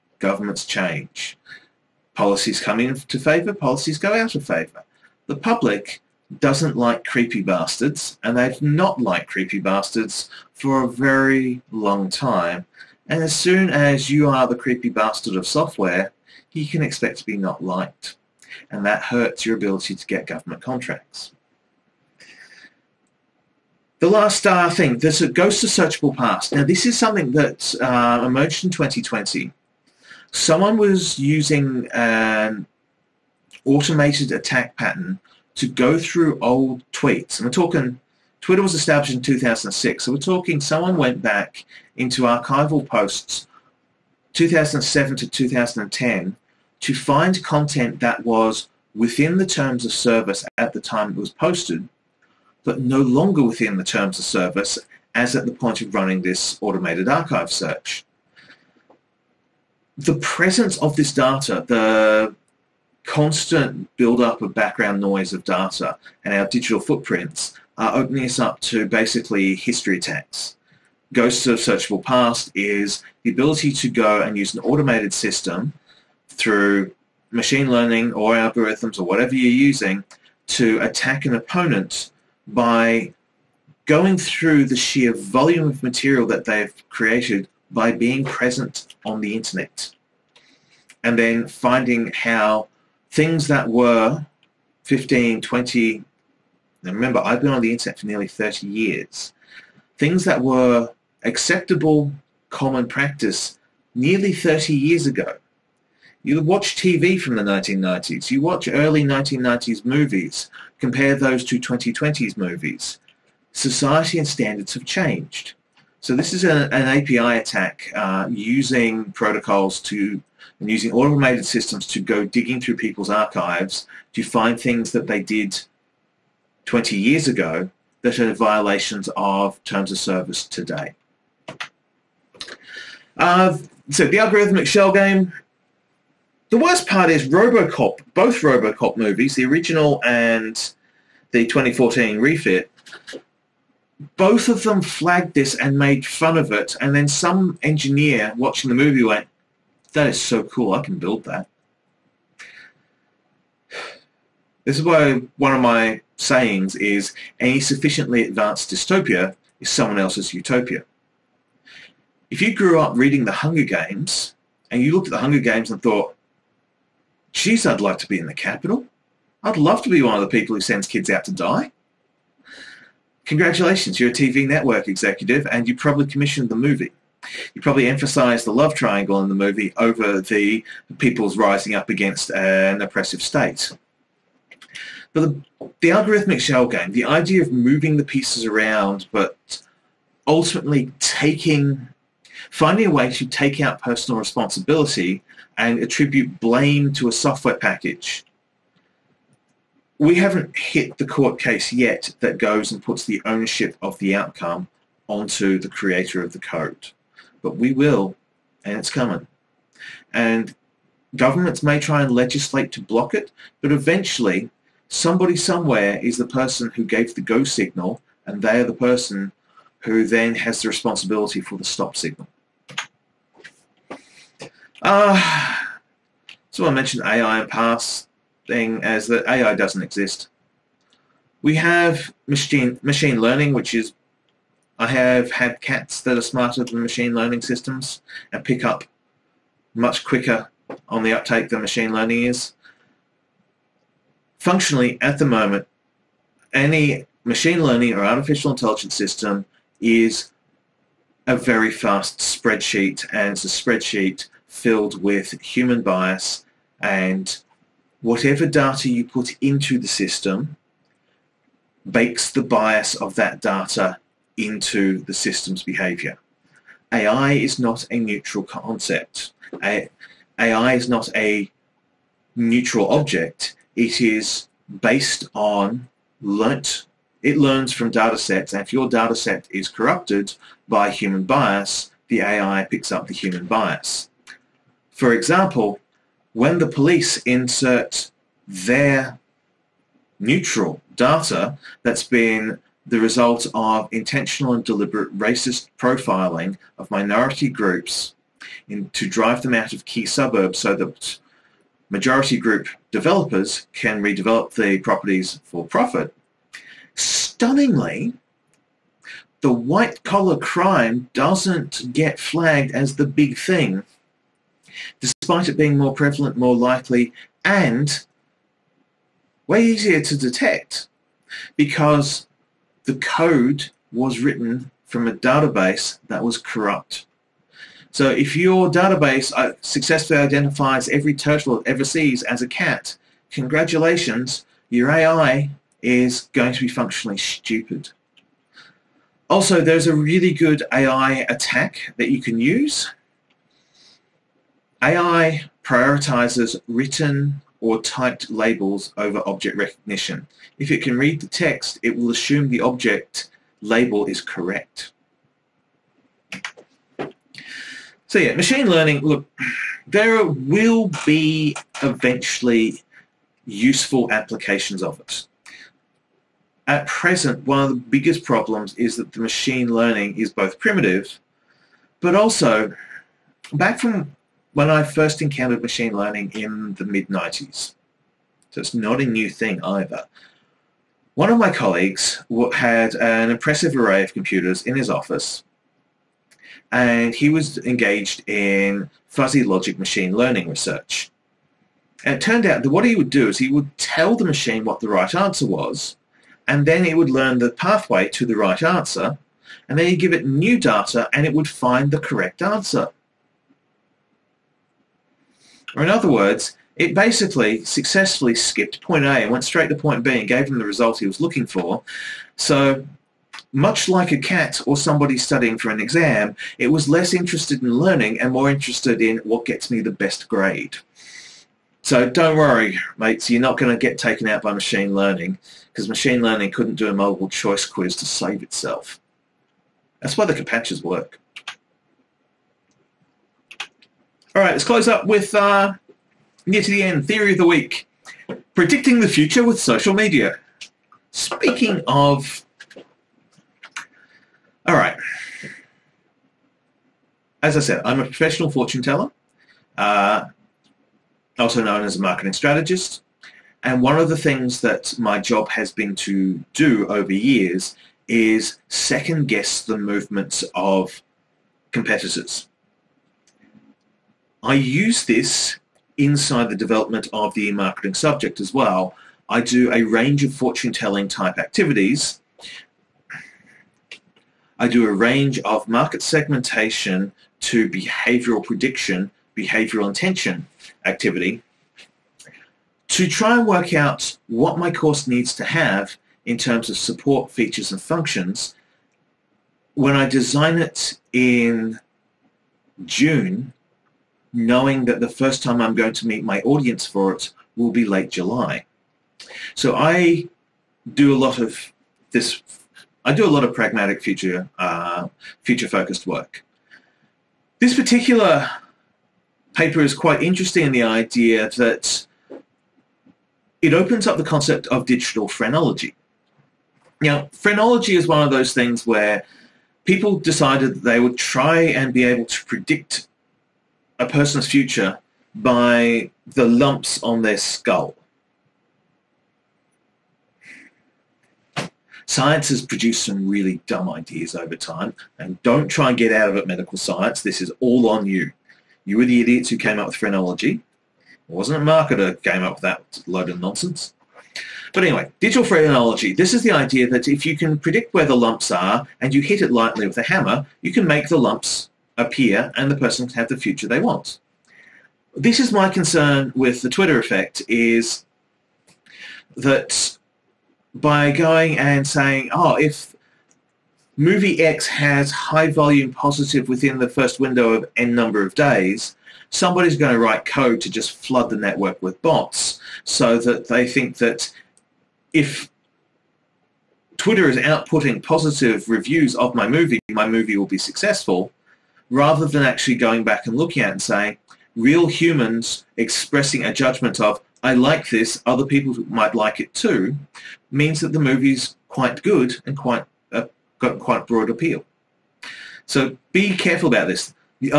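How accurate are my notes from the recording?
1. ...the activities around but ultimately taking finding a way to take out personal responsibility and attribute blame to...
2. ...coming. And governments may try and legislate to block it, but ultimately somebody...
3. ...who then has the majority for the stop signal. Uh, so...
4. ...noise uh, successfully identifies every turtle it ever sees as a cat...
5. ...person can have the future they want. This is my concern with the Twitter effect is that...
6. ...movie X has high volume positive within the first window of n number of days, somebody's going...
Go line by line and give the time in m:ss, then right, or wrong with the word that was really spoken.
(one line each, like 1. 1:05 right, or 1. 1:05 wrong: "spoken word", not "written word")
1. 3:07 wrong: "pieces", not "activities"
2. 3:28 wrong: "eventually", not "ultimately"
3. 3:39 wrong: "responsibility", not "majority"
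4. 5:28 wrong: "database", not "noise"
5. 9:12 right
6. 9:23 right.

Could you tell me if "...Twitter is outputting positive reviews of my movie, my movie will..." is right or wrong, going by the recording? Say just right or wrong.
right.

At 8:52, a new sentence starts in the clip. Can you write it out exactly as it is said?
Science has produced some really dumb ideas over time, and don't try and get out of it, medical science.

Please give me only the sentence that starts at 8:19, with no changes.
So I do a lot of this, I do a lot of pragmatic future, uh, future focused work.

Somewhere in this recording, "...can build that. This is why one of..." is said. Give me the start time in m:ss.
2:30.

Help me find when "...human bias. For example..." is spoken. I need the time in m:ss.
4:43.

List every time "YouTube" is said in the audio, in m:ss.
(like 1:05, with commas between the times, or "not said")
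not said.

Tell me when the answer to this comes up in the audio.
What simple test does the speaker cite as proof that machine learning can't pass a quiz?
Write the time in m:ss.
7:10.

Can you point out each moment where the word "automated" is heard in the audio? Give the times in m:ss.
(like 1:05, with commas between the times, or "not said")
0:33, 0:56, 1:14, 2:00.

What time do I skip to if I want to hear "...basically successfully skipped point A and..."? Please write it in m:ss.
6:46.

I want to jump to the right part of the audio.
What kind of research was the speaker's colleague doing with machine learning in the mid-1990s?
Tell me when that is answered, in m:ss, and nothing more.
6:29.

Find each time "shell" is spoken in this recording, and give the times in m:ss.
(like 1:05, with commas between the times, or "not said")
2:14, 3:06.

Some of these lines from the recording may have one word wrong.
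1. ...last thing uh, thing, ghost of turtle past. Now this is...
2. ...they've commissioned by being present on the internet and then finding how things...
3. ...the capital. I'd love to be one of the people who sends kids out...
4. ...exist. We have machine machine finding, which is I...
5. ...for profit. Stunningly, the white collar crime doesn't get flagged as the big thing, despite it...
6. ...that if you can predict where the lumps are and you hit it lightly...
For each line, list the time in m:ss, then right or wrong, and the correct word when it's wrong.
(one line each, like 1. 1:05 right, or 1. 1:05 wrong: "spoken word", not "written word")
1. 0:24 wrong: "searchable", not "turtle"
2. 1:26 wrong: "created", not "commissioned"
3. 2:48 right
4. 3:49 wrong: "learning", not "finding"
5. 5:05 right
6. 9:06 right.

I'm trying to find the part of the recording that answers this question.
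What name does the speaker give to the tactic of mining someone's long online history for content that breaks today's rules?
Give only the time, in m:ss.
1:11.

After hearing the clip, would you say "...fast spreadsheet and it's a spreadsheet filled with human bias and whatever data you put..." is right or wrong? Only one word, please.
right.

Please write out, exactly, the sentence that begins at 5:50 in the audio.
If it can read the text, it will assume the object label is correct.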